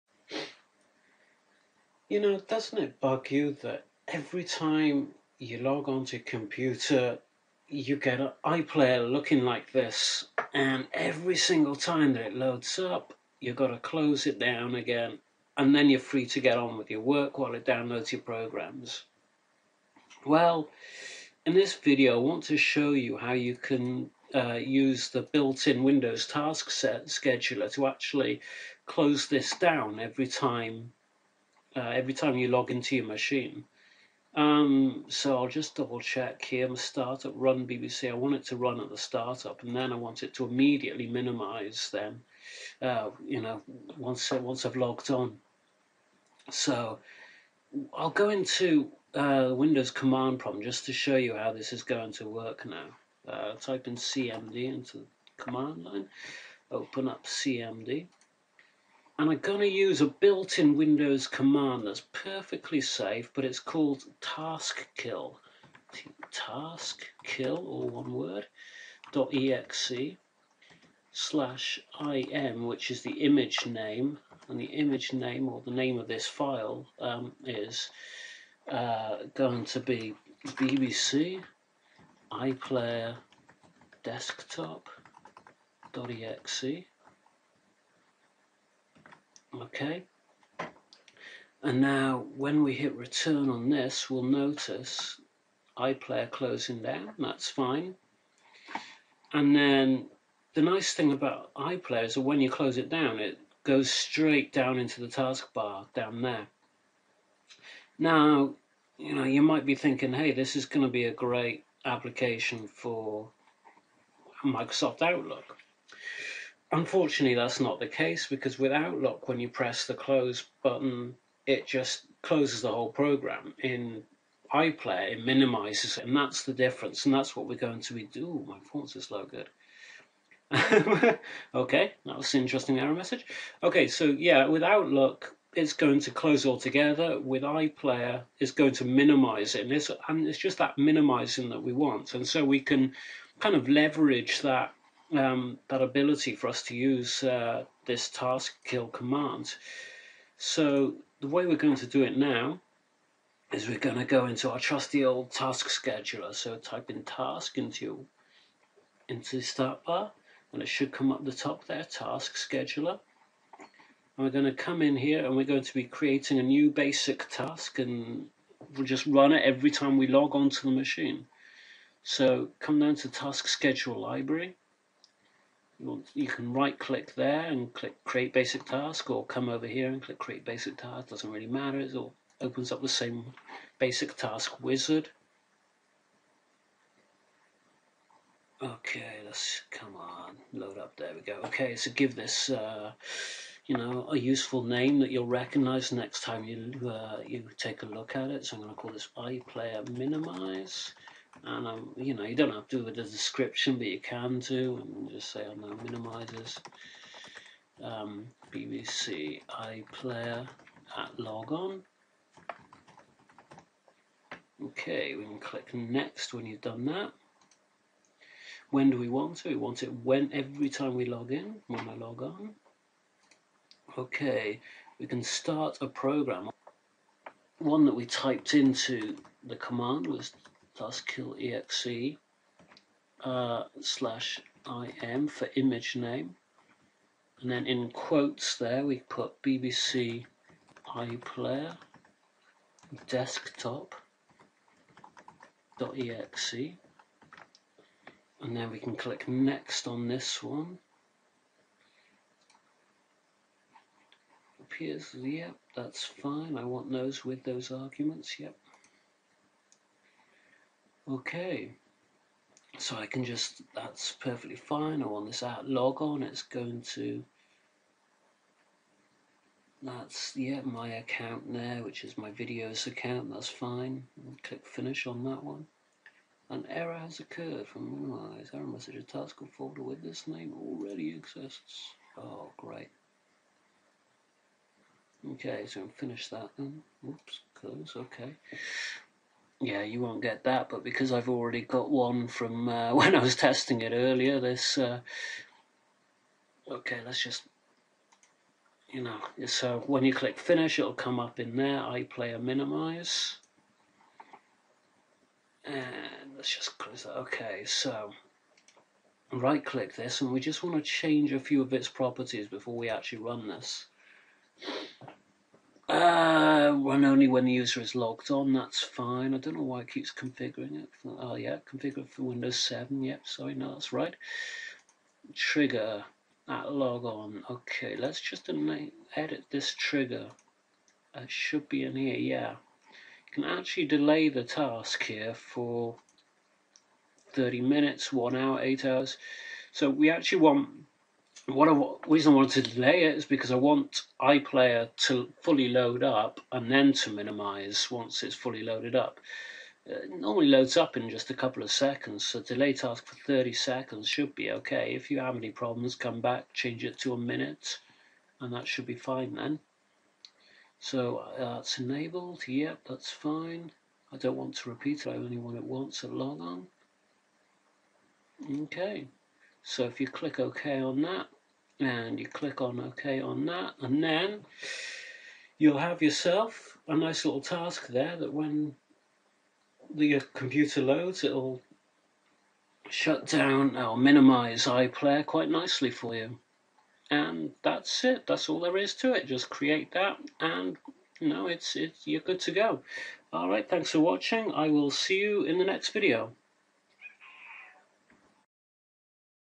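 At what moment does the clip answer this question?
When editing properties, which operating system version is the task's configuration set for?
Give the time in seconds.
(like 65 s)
322 s.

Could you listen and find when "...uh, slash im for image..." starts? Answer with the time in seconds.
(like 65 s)
233 s.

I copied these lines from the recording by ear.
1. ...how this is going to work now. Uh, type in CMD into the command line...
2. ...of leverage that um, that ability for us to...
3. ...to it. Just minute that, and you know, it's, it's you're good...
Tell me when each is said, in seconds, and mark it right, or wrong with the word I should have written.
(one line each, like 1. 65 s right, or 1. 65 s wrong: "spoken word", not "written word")
1. 51 s right
2. 143 s right
3. 388 s wrong: "create", not "minute".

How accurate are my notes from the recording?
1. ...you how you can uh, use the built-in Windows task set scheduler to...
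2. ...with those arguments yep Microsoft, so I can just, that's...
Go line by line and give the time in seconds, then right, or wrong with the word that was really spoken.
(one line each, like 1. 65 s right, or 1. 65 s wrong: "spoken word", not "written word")
1. 22 s right
2. 257 s wrong: "Okay", not "Microsoft".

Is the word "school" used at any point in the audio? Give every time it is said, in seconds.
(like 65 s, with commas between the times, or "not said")
not said.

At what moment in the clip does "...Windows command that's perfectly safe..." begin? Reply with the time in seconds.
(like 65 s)
60 s.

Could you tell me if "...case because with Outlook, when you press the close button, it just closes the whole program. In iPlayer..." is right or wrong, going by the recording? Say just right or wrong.
right.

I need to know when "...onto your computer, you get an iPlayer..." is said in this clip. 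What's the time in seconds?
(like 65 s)
5 s.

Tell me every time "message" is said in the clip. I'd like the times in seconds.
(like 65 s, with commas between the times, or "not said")
132 s, 278 s.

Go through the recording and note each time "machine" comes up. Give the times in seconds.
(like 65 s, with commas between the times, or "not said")
33 s, 170 s.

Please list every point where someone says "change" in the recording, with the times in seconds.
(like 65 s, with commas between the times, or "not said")
310 s, 356 s.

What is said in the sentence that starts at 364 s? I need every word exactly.
I don't want to repeat it, I only want it once at log on.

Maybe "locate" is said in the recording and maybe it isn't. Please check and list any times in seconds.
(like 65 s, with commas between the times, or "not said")
not said.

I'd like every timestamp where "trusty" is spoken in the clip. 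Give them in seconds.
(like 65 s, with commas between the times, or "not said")
154 s.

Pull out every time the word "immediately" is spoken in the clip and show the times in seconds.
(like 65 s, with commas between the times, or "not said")
40 s.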